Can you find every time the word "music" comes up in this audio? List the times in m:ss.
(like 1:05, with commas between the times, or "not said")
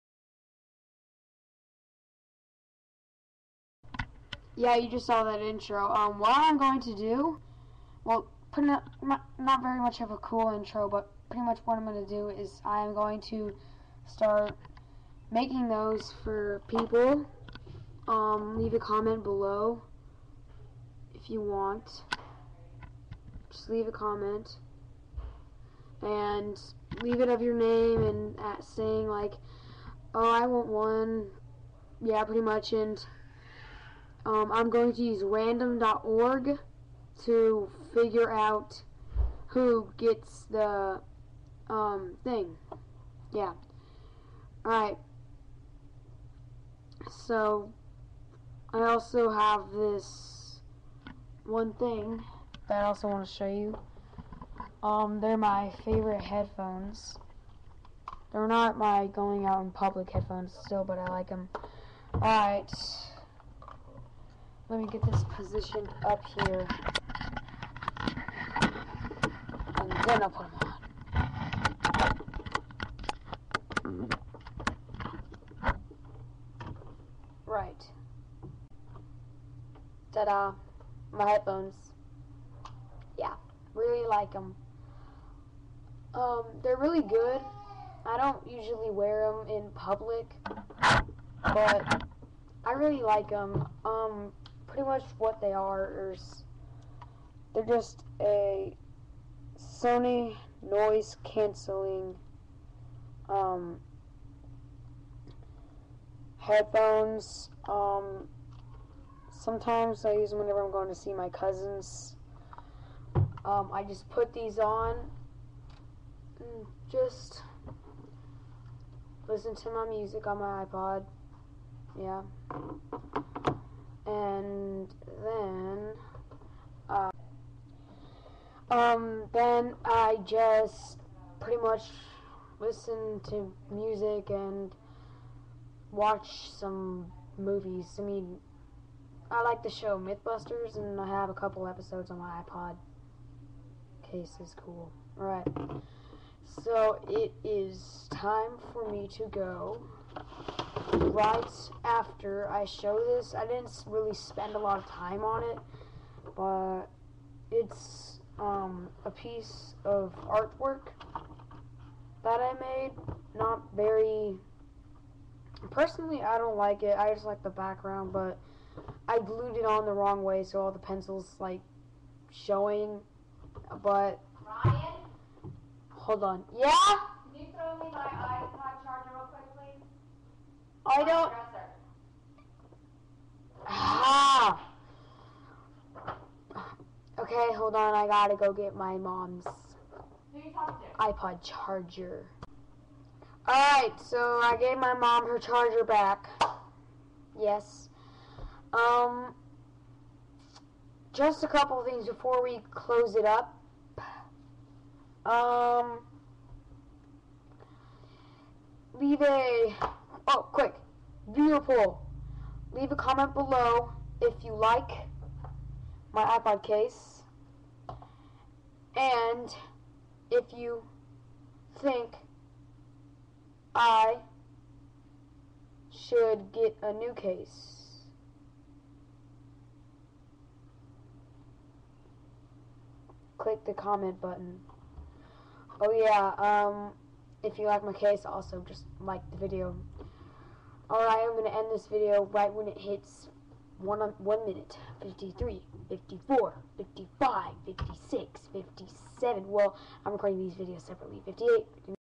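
1:59, 2:13.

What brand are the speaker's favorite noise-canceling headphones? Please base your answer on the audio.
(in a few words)
Sony.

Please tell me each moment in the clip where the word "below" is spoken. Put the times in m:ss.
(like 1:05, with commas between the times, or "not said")
0:19, 3:33.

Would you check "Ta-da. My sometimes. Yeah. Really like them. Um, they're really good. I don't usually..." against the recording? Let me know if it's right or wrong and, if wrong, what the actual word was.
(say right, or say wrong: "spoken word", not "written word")
wrong: "headphones", not "sometimes".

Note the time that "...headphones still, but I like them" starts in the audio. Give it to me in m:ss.
1:00.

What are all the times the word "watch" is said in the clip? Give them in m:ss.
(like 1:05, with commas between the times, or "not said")
2:15.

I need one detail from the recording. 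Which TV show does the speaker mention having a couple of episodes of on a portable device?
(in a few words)
MythBusters.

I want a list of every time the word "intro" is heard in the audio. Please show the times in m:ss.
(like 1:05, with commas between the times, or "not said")
0:05, 0:10.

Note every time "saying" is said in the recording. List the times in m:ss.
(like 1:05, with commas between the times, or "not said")
0:28.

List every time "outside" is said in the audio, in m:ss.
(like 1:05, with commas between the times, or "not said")
not said.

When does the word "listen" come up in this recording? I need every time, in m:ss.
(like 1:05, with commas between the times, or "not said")
1:59, 2:12.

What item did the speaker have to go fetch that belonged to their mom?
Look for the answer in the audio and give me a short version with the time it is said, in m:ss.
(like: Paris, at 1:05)
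iPod charger, at 3:10.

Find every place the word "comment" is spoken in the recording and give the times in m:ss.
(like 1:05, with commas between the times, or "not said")
0:18, 0:23, 3:32, 3:53.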